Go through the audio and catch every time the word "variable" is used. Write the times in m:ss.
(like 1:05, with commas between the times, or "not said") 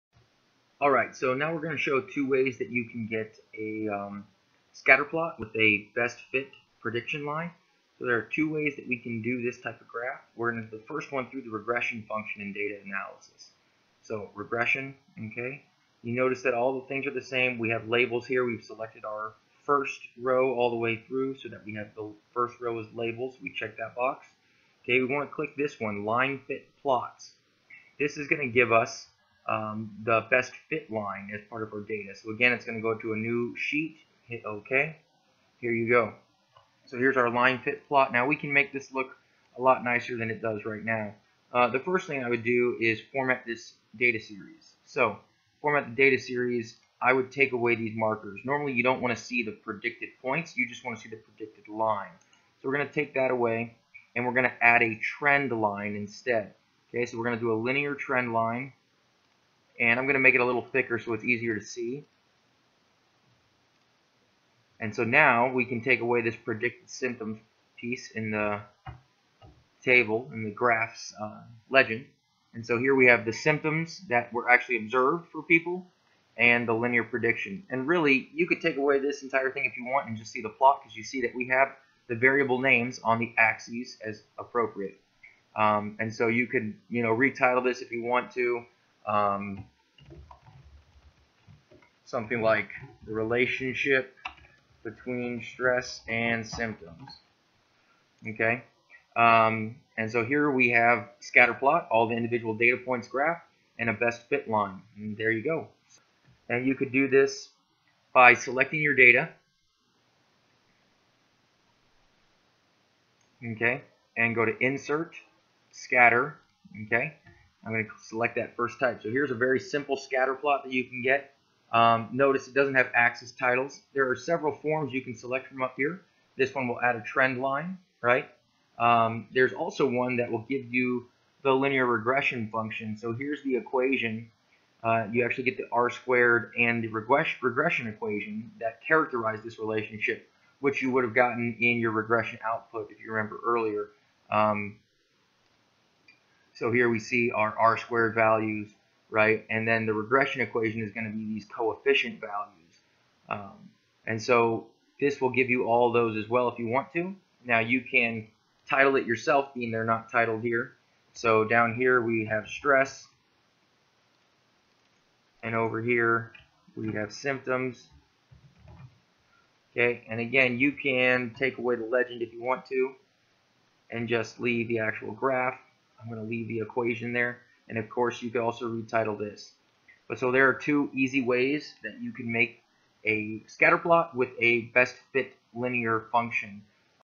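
1:22.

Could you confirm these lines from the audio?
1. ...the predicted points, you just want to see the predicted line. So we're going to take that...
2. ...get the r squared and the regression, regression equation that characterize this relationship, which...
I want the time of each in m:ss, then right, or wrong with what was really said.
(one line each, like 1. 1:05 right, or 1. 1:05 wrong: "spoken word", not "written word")
1. 0:49 right
2. 2:15 right.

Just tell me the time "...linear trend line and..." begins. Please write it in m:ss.
0:57.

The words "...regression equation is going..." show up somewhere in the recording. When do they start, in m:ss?
2:29.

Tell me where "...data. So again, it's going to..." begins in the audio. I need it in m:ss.
0:31.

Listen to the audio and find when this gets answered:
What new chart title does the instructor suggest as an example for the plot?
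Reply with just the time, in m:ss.
1:33.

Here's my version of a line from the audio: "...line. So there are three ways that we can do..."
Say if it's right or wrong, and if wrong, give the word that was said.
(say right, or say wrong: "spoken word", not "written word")
wrong: "two", not "three".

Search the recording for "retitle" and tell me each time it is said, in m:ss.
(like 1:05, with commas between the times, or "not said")
1:27, 2:58.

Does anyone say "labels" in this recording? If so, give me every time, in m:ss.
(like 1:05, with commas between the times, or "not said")
0:17, 0:22.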